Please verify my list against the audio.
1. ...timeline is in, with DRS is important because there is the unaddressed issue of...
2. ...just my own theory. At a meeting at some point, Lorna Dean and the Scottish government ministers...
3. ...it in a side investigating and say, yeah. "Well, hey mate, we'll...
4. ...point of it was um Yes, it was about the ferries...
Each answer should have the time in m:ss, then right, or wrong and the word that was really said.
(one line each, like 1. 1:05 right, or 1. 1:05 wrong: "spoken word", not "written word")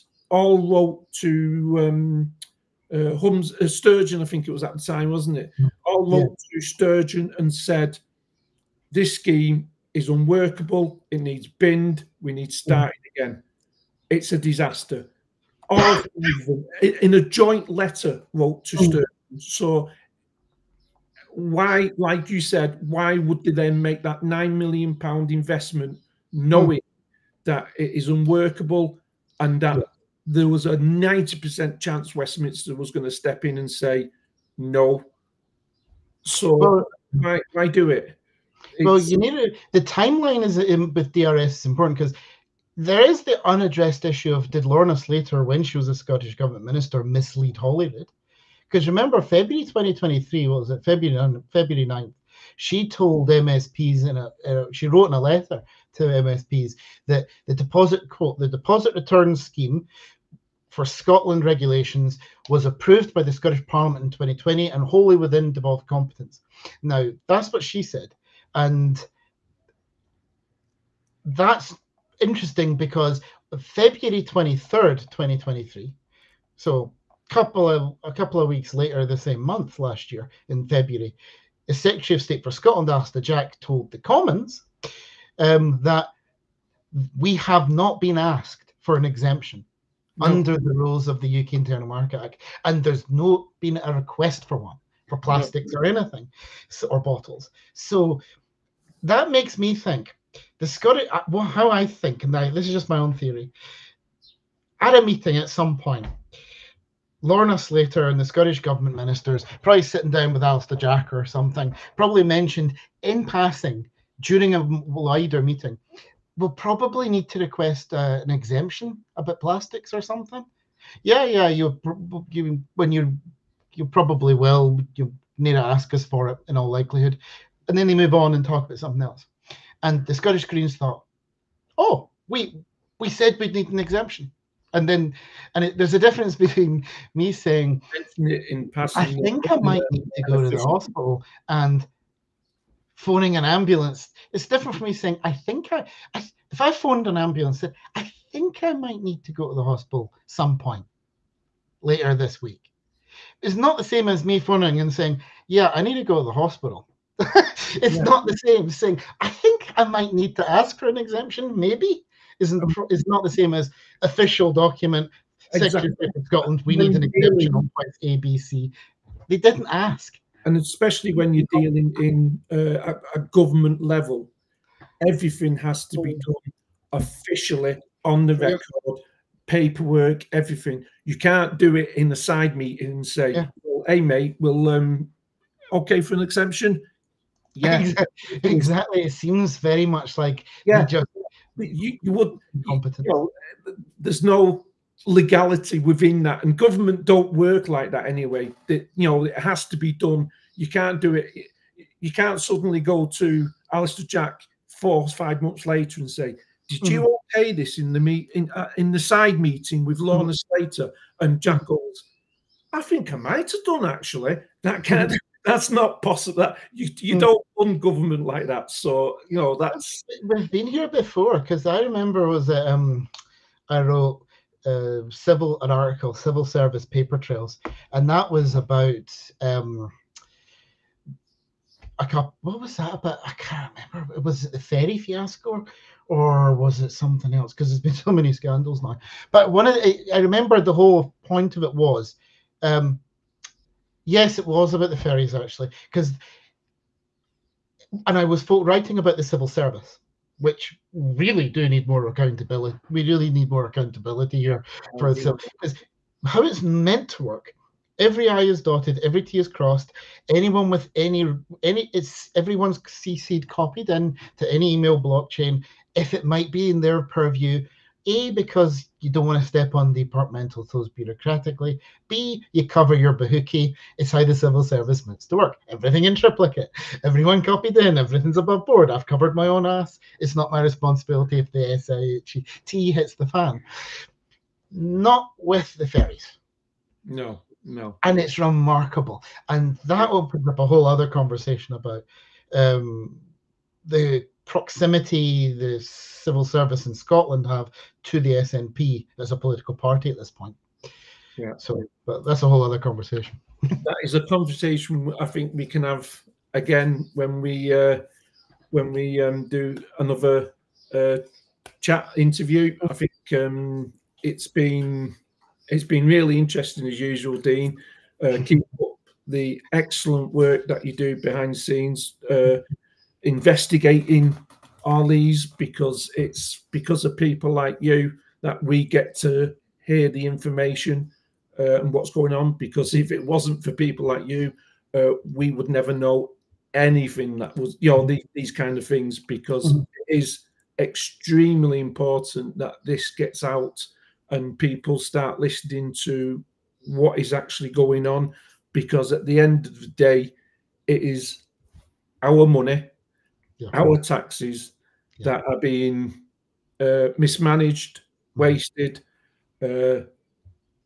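1. 0:39 right
2. 1:42 wrong: "Slater", not "Dean"
3. 3:01 wrong: "meeting", not "investigating"
4. 4:01 right.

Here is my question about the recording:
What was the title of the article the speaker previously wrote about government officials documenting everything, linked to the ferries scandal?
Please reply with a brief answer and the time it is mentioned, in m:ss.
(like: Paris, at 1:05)
Civil service paper trails, at 3:46.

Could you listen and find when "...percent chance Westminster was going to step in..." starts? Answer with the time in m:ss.
0:31.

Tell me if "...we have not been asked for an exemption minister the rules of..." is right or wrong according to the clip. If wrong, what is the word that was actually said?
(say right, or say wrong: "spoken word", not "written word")
wrong: "under", not "minister".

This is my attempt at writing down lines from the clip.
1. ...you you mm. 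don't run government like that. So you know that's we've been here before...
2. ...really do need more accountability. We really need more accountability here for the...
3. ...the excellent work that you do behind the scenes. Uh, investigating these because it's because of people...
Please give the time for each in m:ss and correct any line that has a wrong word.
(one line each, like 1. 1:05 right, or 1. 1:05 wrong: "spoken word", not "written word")
1. 3:36 right
2. 4:10 right
3. 5:19 right.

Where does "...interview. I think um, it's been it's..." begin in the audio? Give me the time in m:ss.
5:12.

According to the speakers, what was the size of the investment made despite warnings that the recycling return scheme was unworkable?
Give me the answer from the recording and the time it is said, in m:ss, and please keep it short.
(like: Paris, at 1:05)
9 million pounds, at 0:24.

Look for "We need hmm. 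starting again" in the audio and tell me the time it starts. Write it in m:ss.
0:12.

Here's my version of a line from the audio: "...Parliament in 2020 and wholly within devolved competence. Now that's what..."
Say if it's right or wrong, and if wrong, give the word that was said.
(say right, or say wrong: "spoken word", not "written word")
right.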